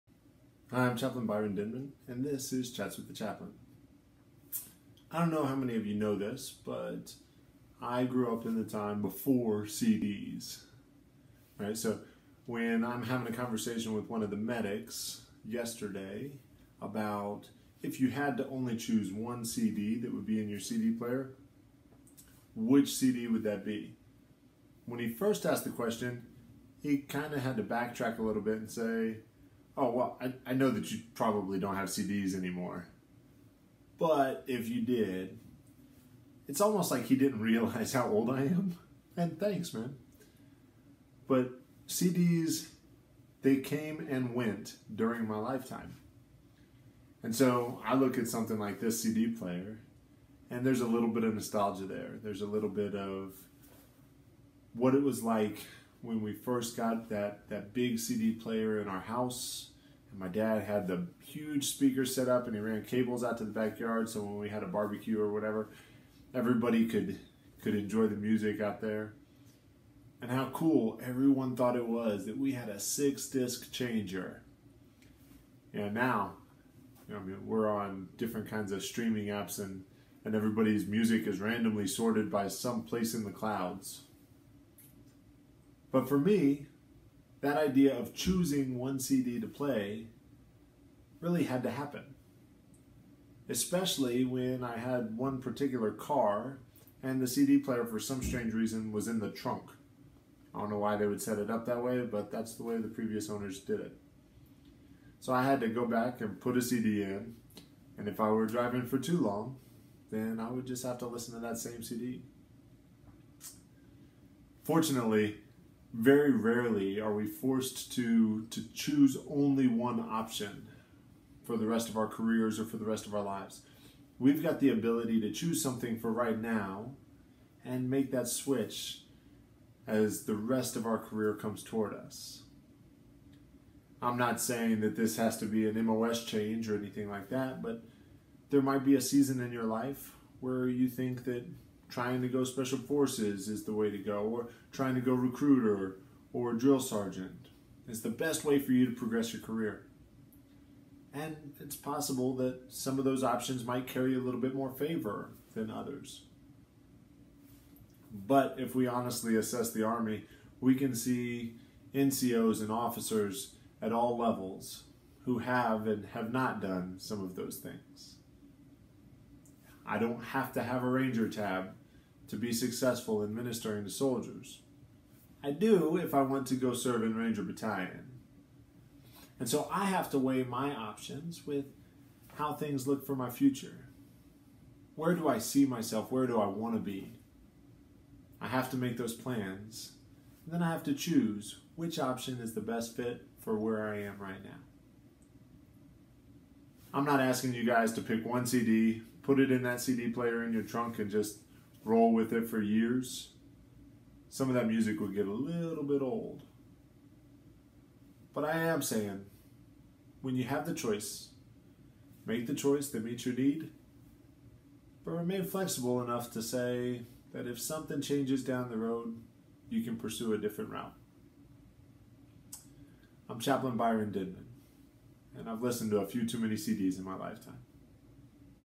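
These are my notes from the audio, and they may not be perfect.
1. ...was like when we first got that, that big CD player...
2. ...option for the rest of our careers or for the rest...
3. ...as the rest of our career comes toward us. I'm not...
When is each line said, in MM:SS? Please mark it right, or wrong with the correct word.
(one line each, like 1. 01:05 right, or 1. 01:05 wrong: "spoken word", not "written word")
1. 00:55 right
2. 01:59 right
3. 02:09 right.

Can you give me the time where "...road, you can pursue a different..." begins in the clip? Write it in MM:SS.
03:38.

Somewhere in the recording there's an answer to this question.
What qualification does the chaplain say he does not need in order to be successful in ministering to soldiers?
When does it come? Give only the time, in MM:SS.
02:50.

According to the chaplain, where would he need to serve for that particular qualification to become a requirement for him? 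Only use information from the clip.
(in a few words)
Ranger Battalion.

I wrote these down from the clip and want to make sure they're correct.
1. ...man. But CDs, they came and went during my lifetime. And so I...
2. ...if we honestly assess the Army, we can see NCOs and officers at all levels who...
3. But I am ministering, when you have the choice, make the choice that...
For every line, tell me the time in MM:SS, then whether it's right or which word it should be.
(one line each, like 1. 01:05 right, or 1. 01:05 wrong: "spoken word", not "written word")
1. 00:39 right
2. 02:38 right
3. 03:28 wrong: "saying", not "ministering".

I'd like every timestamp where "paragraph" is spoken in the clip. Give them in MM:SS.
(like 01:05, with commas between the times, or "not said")
not said.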